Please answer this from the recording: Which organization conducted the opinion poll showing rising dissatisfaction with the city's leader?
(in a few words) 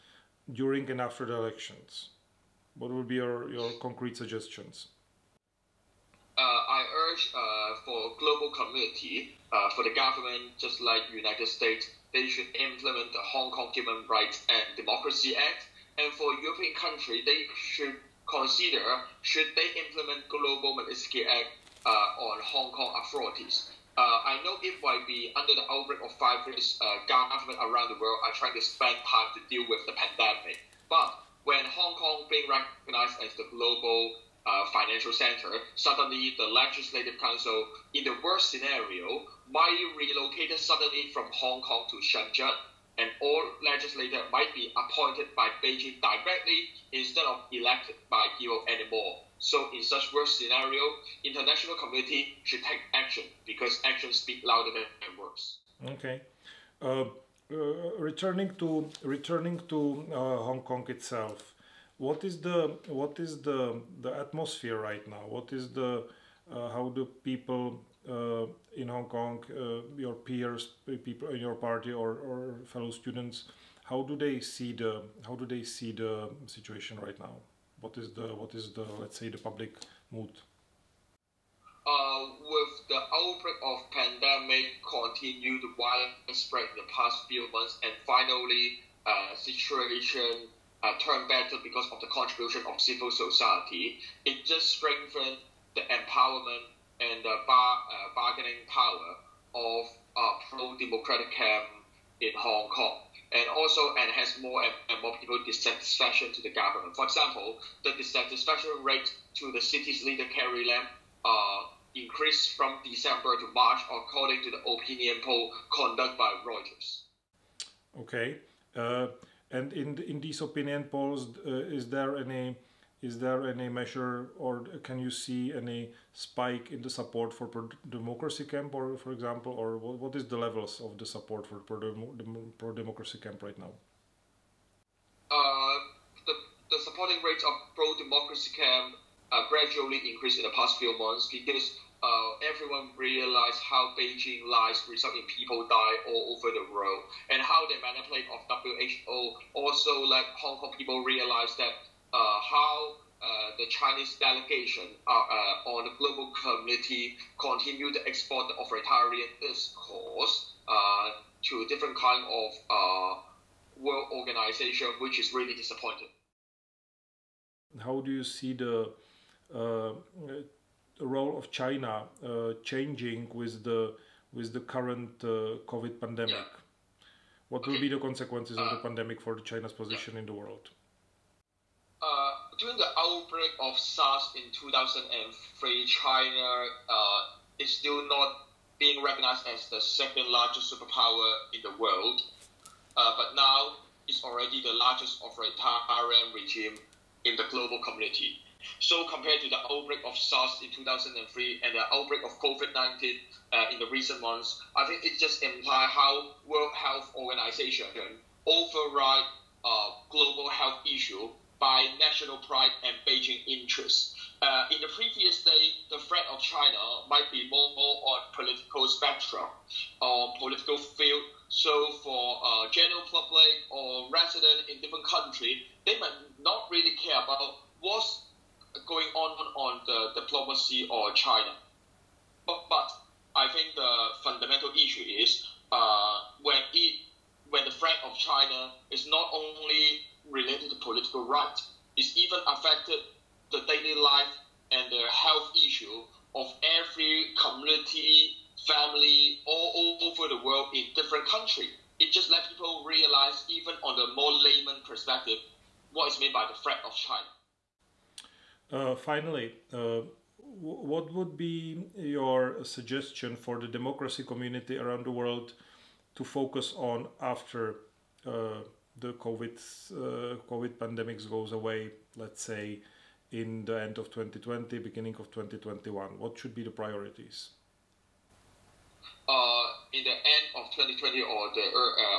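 Reuters.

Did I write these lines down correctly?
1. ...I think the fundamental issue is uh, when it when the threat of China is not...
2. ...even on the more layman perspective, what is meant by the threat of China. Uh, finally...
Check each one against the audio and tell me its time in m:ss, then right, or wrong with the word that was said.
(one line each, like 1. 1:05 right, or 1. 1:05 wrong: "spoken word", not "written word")
1. 3:53 right
2. 4:13 right.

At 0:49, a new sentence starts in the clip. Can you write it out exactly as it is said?
So, in such worst scenario, international community should take action because action speak louder than words.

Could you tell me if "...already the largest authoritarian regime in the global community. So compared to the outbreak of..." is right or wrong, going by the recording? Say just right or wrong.
right.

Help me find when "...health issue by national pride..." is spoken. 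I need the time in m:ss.
3:30.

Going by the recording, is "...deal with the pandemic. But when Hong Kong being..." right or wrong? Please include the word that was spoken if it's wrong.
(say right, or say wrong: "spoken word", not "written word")
right.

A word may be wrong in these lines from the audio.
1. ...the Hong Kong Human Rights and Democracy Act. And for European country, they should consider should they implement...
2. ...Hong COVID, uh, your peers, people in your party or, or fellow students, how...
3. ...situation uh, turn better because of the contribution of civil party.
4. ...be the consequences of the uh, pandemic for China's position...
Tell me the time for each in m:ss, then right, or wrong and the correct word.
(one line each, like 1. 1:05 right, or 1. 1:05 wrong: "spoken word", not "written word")
1. 0:13 right
2. 1:08 wrong: "Kong", not "COVID"
3. 1:29 wrong: "society", not "party"
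4. 2:57 right.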